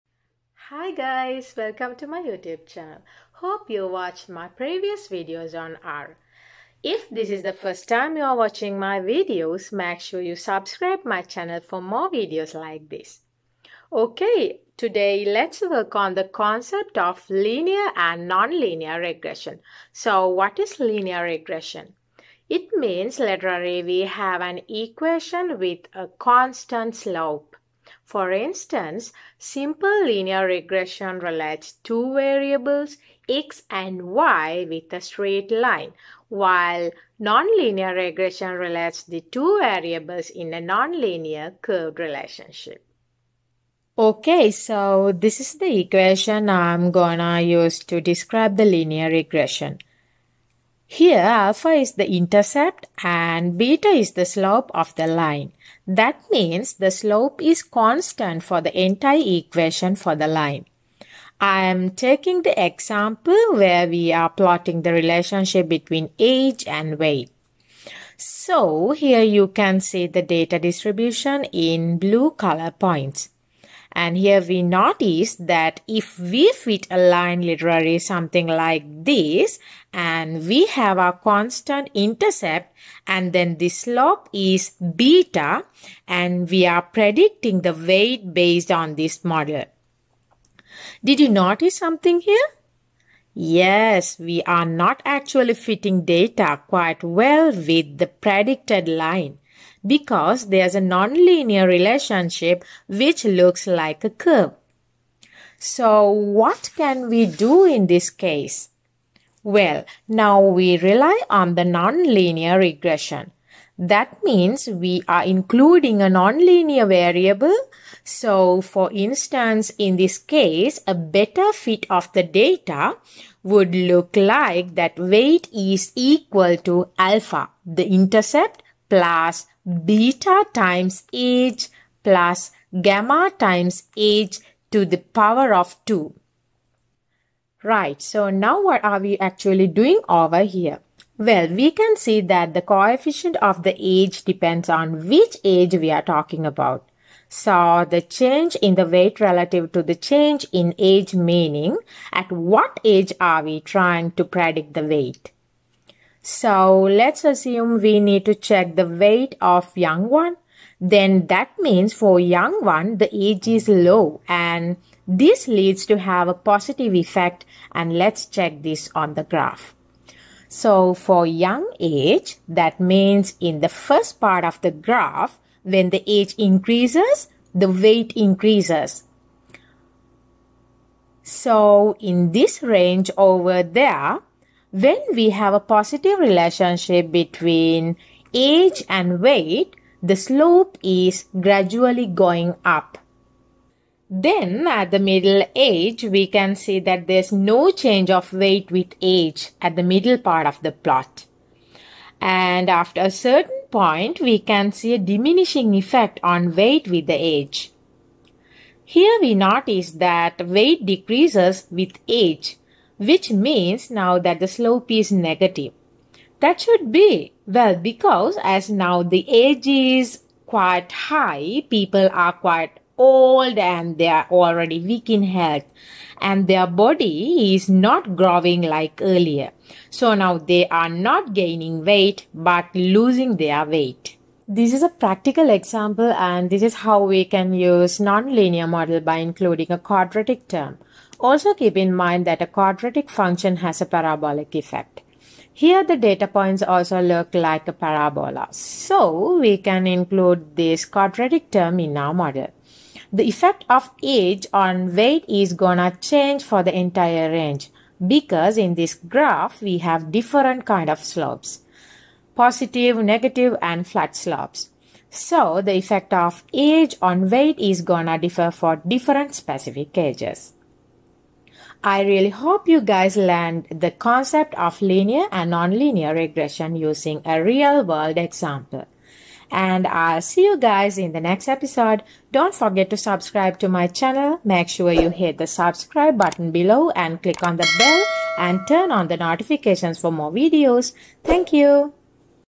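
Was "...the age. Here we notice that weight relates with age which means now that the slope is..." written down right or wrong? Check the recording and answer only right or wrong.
wrong.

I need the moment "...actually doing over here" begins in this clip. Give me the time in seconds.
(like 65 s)
139 s.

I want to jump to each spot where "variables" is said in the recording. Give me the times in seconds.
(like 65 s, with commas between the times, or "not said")
32 s, 39 s, 116 s.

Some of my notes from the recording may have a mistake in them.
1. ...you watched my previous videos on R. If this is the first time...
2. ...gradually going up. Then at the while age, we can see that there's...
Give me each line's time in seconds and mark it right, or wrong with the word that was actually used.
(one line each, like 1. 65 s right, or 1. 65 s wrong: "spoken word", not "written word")
1. 3 s right
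2. 191 s wrong: "middle", not "while".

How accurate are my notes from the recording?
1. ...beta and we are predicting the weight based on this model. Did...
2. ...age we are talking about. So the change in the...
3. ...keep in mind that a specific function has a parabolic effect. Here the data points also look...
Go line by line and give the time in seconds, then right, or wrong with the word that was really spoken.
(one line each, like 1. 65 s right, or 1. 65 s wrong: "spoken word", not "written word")
1. 84 s right
2. 145 s right
3. 241 s wrong: "quadratic", not "specific".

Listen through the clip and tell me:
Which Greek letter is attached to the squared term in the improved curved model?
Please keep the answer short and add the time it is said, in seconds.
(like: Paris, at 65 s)
gamma, at 132 s.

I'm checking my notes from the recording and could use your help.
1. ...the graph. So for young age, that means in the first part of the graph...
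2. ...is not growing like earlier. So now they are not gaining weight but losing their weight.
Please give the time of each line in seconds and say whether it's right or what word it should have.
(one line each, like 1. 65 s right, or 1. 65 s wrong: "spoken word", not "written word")
1. 169 s right
2. 227 s right.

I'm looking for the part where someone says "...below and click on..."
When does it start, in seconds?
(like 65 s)
286 s.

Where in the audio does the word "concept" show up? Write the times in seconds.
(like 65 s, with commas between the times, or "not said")
16 s, 273 s.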